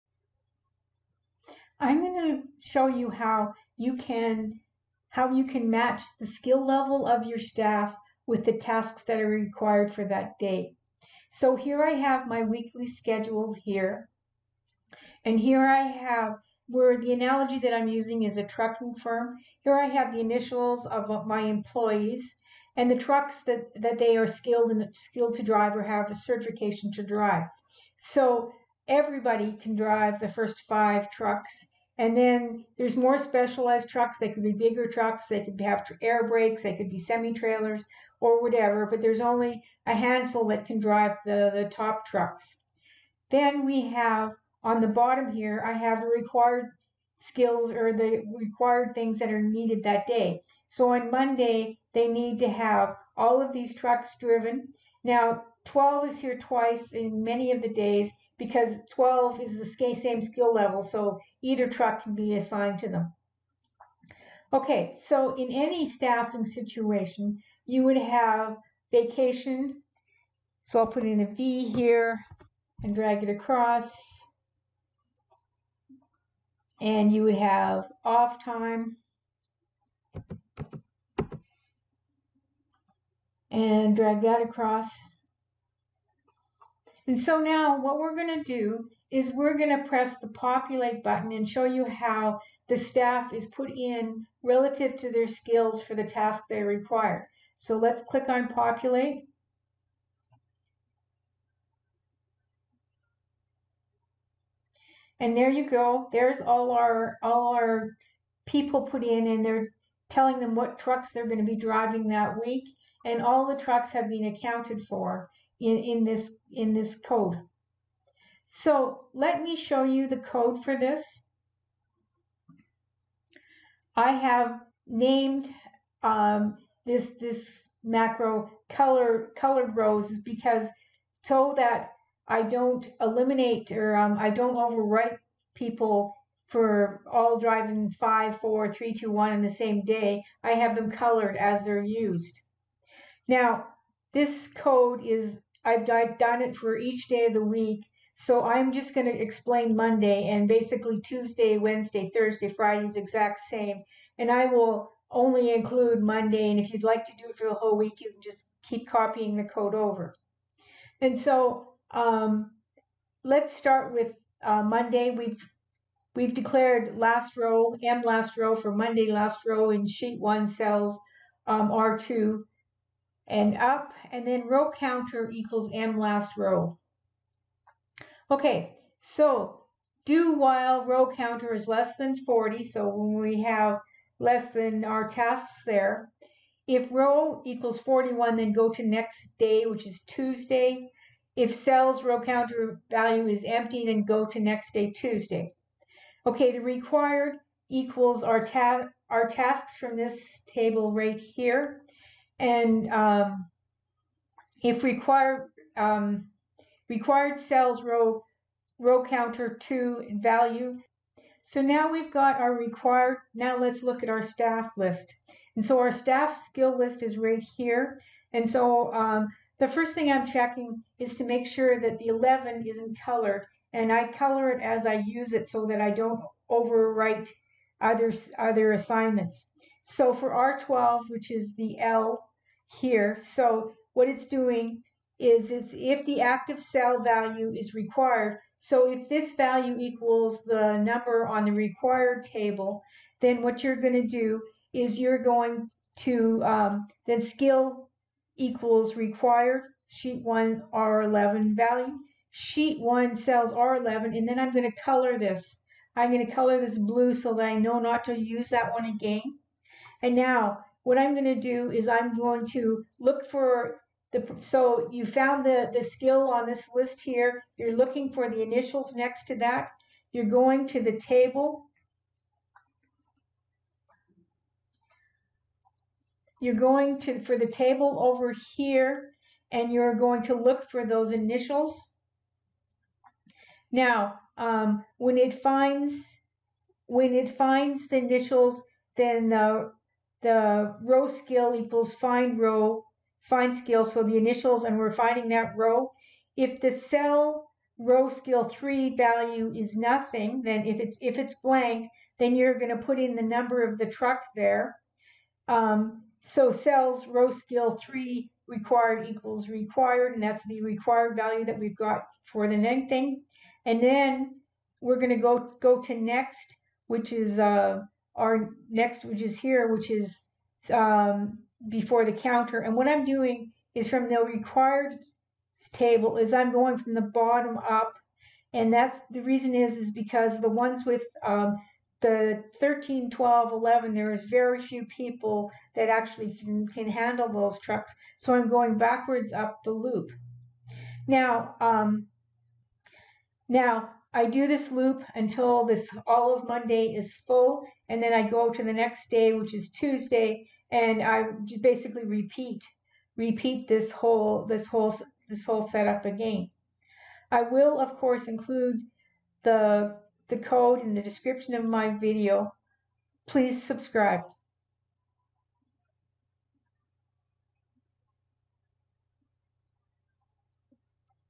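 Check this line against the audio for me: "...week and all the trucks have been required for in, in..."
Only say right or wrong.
wrong.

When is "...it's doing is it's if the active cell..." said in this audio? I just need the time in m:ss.
3:54.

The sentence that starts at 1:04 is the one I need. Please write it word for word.
Okay, so in any staffing situation, you would have vacation.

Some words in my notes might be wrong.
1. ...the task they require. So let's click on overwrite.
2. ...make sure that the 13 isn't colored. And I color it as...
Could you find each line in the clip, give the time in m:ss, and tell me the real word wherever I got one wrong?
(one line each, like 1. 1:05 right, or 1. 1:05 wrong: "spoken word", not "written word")
1. 1:35 wrong: "populate", not "overwrite"
2. 3:41 wrong: "11", not "13".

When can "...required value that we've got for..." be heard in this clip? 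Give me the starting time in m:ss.
5:10.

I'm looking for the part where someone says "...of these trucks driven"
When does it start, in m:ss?
0:53.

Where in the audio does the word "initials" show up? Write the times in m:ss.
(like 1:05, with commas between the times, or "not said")
0:20, 4:28, 4:41, 4:47, 4:54.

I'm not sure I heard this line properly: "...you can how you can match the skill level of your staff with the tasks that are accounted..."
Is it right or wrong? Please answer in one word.
wrong.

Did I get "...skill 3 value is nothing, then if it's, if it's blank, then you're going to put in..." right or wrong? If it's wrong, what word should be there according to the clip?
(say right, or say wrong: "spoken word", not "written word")
right.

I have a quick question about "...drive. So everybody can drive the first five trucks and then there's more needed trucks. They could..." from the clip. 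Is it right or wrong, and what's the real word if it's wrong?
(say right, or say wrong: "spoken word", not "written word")
wrong: "specialized", not "needed".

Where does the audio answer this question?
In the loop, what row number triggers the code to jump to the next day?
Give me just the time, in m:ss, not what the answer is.
3:07.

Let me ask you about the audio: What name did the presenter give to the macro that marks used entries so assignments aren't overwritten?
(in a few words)
Colored rows.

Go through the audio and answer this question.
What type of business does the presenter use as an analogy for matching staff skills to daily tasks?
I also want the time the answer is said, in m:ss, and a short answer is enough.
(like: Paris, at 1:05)
Trucking firm, at 0:18.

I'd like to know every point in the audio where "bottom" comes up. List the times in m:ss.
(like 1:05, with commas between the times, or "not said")
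0:44, 5:27.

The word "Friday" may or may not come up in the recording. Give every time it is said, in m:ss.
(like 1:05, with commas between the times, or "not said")
2:32.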